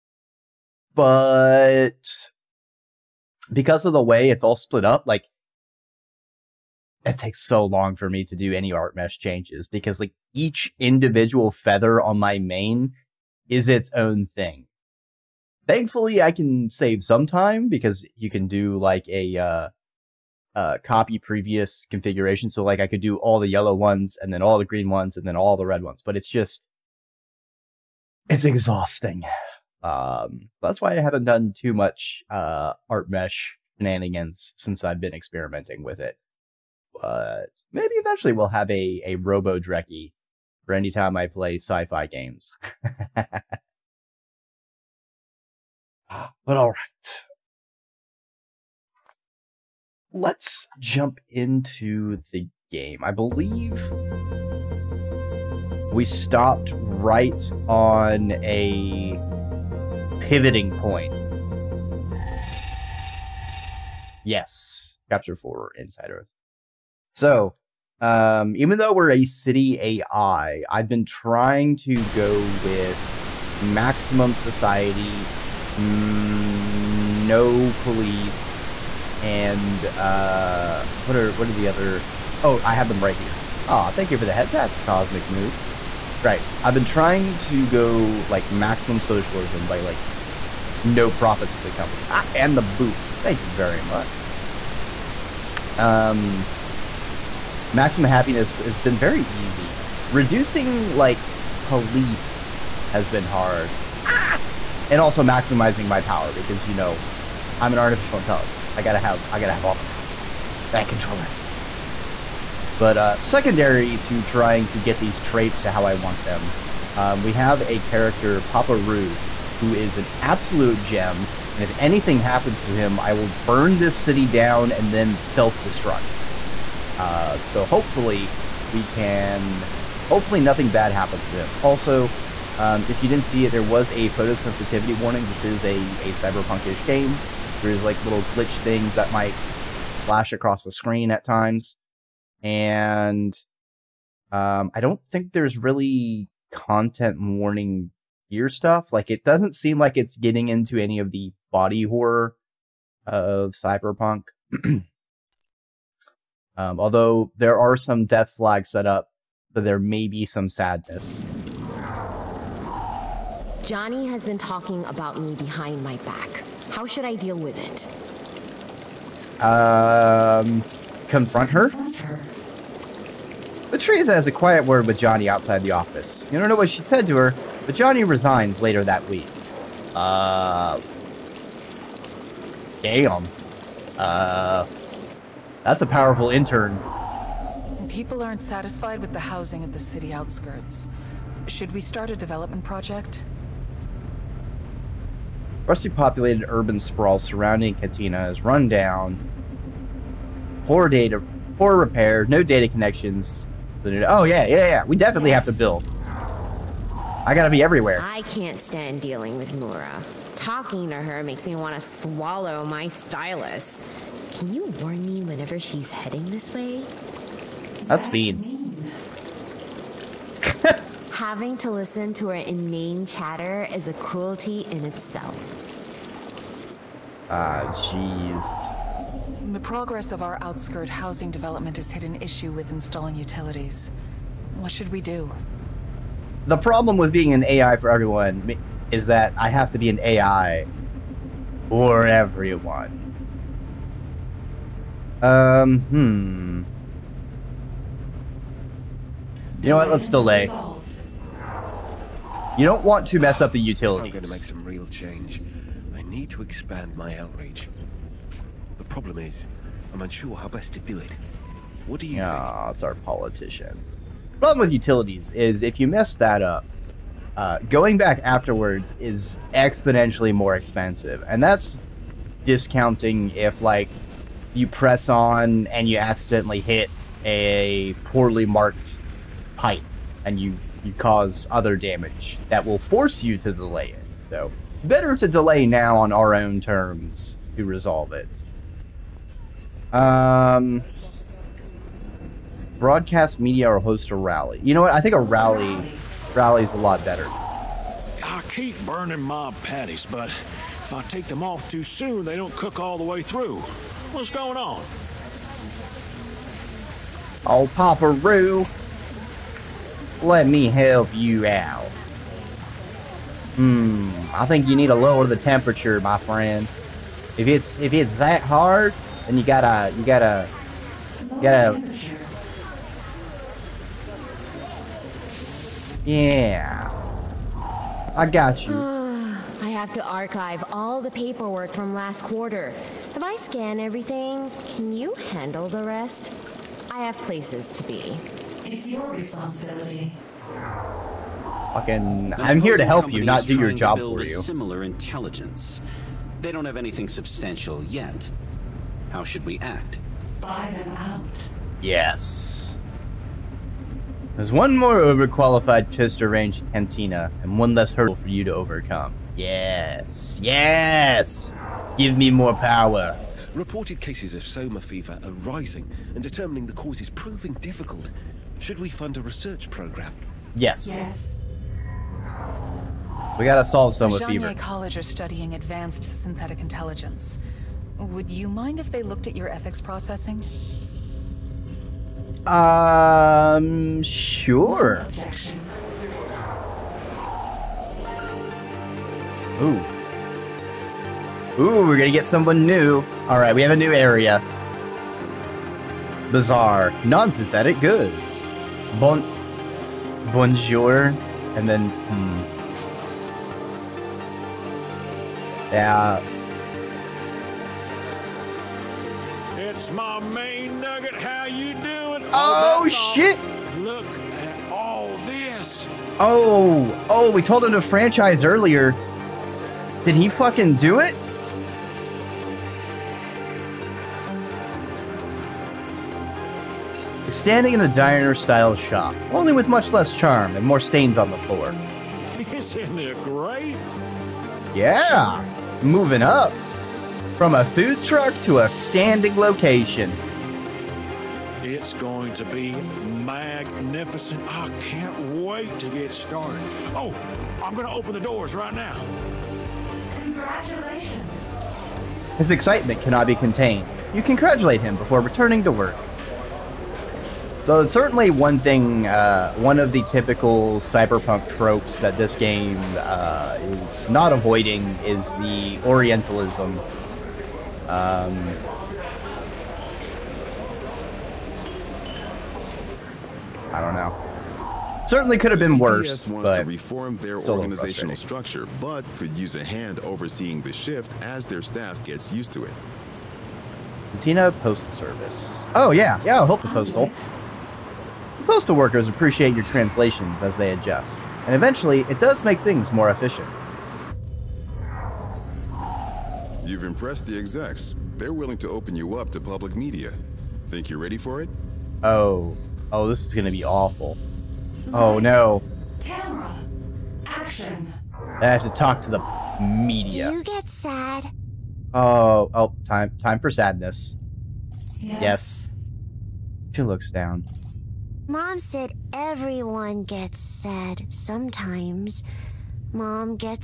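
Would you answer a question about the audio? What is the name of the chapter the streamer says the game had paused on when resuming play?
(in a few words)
Insider Threat.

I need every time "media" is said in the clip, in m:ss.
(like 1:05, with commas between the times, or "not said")
4:53, 8:19, 8:29.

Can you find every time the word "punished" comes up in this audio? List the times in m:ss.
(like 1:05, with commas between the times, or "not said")
not said.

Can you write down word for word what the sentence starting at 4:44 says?
So, better to delay now on our own terms to resolve it.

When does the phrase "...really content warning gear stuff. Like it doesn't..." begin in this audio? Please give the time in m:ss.
2:25.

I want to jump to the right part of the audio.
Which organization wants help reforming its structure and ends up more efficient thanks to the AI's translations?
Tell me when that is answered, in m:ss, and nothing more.
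8:04.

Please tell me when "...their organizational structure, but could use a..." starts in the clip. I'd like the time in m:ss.
7:57.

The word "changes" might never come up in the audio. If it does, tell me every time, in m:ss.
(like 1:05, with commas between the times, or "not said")
0:09, 4:14.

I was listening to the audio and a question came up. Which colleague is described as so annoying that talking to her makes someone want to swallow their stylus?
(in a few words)
Mura.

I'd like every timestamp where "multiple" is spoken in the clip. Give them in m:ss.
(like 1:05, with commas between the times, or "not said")
not said.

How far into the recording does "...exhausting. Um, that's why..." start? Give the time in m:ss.
0:28.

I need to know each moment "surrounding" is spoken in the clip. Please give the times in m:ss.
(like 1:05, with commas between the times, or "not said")
3:17.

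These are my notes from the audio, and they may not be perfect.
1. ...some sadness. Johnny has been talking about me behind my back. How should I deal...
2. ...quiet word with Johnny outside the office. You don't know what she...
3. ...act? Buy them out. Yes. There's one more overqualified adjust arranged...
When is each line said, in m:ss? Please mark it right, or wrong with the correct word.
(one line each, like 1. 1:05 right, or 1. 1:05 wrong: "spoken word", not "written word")
1. 2:40 right
2. 2:54 right
3. 5:49 wrong: "chest", not "adjust".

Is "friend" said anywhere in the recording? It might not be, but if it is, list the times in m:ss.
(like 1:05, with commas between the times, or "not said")
5:16.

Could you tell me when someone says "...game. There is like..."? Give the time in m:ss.
2:16.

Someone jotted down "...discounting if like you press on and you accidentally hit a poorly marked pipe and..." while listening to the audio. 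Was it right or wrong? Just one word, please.
right.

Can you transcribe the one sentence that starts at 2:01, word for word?
And if anything happens to him, I will burn this city down and then self destruct.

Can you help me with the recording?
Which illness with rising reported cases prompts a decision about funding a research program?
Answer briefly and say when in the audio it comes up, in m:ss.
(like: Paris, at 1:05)
soma fever, at 6:04.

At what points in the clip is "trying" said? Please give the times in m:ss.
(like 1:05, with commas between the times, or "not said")
1:11, 1:26, 1:54.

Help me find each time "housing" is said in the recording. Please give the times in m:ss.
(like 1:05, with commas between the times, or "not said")
3:09, 3:50.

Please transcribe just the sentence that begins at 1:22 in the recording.
Oh, I have them right here.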